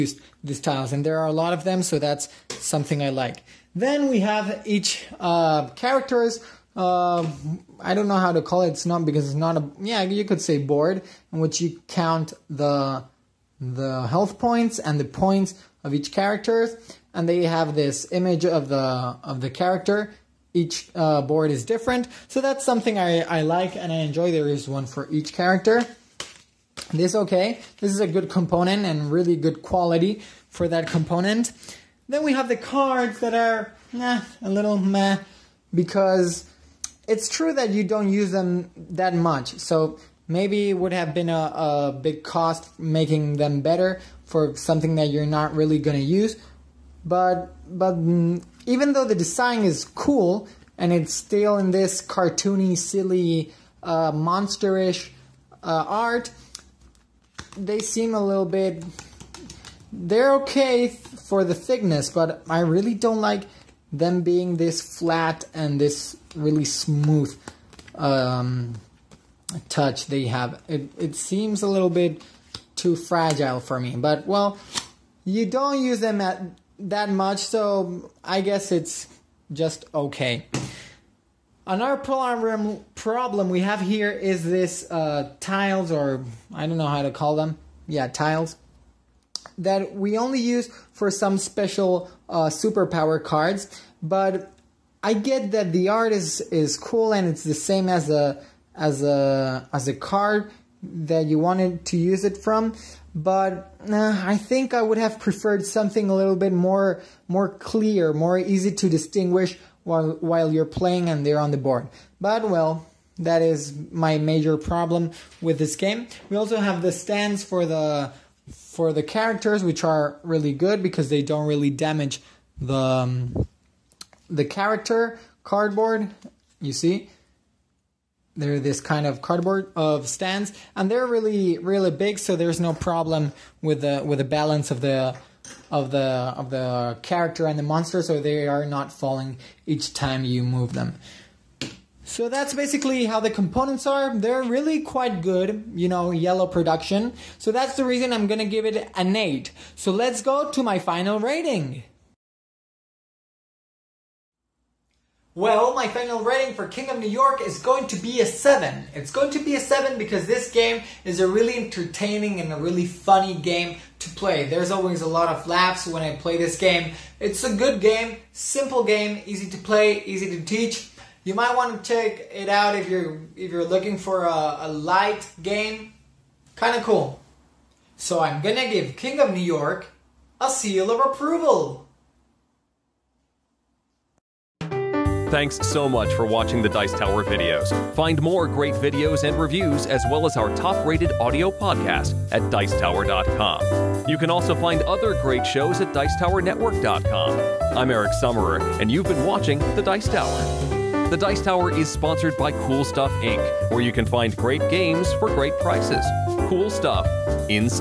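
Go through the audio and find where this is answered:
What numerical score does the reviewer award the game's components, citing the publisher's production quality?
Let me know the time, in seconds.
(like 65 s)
149 s.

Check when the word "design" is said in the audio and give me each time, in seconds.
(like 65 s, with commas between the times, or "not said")
49 s.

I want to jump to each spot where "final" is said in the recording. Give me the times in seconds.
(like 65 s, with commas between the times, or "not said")
150 s, 155 s.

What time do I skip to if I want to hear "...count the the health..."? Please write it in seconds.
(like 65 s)
11 s.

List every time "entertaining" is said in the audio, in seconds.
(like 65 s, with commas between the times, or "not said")
161 s.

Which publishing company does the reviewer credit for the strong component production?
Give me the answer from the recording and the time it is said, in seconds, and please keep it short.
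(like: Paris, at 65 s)
IELLO, at 146 s.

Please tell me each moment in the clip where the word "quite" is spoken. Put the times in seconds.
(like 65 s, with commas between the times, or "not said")
144 s.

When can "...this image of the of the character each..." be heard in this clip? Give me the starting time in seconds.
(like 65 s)
17 s.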